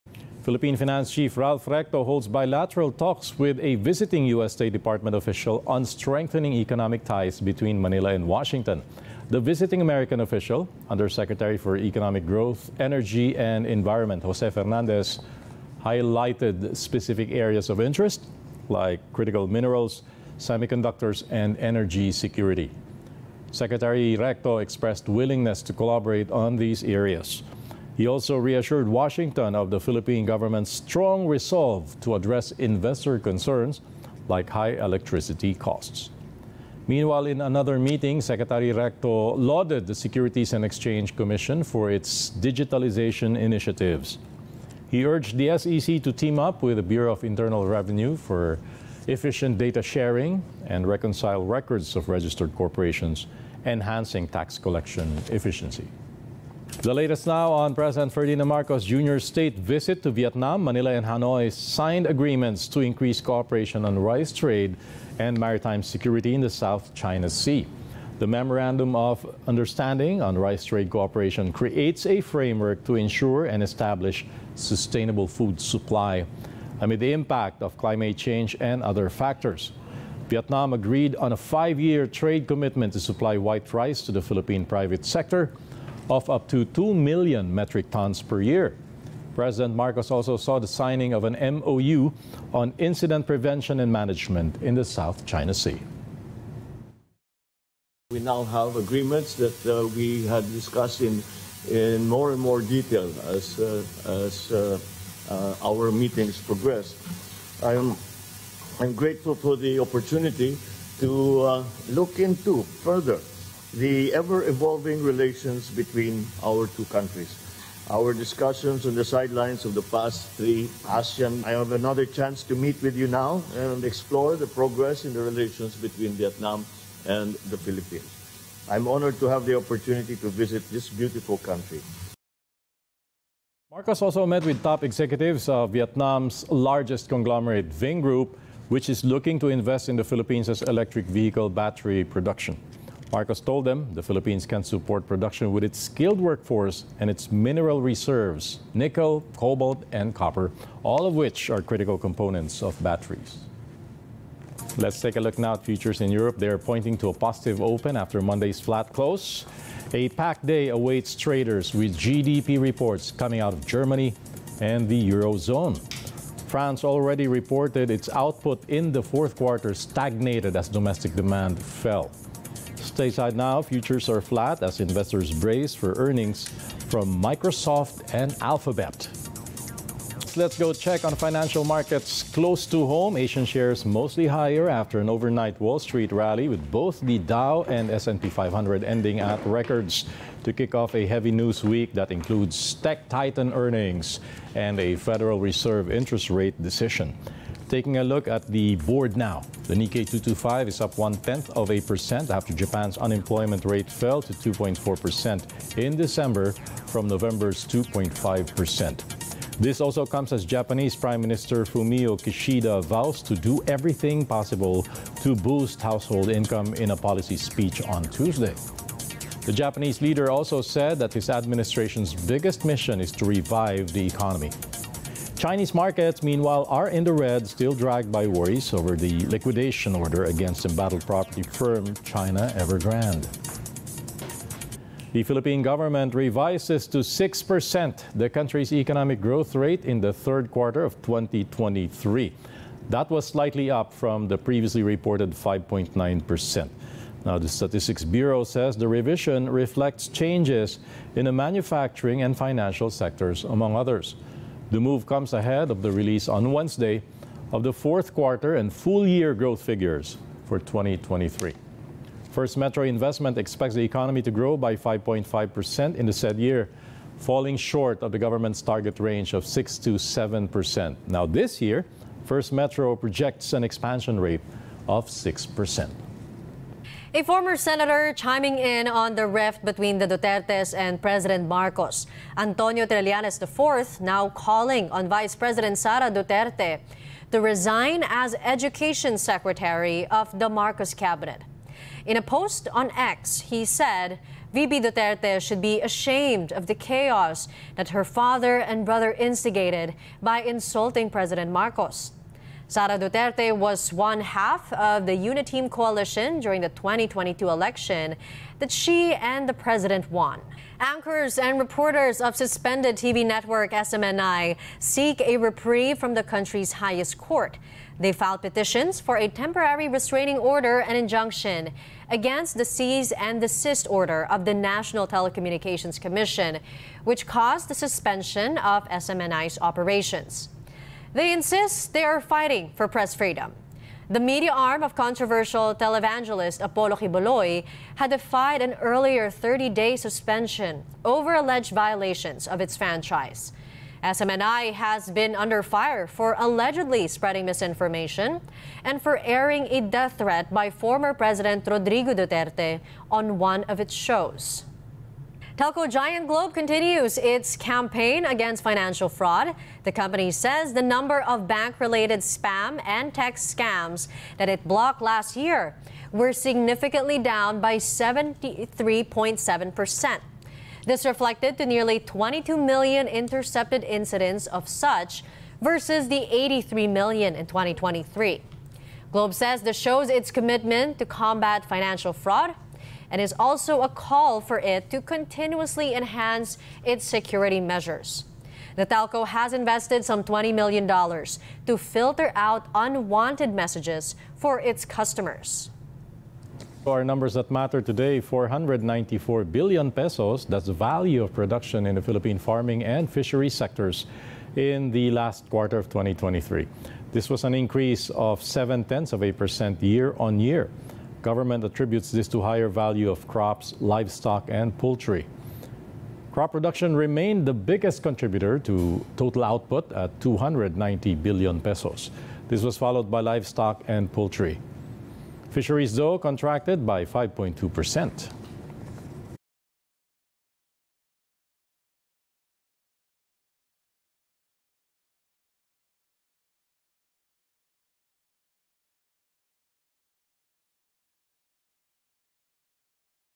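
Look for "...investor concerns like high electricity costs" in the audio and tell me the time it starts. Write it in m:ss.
0:32.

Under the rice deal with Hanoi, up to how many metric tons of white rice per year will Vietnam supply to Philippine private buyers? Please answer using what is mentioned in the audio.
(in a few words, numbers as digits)
2 million.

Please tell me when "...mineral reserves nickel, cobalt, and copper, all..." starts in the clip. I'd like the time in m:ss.
2:27.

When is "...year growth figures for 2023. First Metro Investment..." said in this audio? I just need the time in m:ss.
4:19.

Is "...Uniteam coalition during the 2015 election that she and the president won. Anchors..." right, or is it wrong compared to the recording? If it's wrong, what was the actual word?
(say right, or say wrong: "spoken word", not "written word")
wrong: "2022", not "2015".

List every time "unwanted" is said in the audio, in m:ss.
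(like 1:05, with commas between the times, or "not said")
6:32.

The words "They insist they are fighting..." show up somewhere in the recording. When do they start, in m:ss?
5:31.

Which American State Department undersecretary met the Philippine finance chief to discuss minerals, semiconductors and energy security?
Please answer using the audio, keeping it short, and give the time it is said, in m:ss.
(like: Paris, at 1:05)
Jose Fernandez, at 0:14.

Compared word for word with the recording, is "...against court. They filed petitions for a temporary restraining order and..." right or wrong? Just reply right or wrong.
wrong.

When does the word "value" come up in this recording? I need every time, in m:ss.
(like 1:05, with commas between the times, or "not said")
6:40, 6:52.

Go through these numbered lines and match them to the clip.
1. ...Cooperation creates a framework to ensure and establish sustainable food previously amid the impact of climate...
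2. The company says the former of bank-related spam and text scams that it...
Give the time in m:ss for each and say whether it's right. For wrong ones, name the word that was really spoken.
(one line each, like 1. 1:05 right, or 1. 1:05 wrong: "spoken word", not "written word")
1. 1:10 wrong: "supply", not "previously"
2. 5:59 wrong: "number", not "former".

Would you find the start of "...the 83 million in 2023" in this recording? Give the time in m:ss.
6:16.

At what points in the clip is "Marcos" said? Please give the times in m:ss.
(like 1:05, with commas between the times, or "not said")
0:58, 1:29, 2:13, 2:23, 4:41, 4:50, 5:01.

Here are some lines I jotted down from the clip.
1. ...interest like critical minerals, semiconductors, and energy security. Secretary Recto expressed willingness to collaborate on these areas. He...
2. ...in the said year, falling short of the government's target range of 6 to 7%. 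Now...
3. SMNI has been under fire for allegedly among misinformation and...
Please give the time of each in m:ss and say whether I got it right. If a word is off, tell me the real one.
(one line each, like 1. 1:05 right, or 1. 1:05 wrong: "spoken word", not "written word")
1. 0:17 right
2. 4:25 right
3. 5:44 wrong: "spreading", not "among".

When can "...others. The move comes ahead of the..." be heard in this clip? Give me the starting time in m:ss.
4:13.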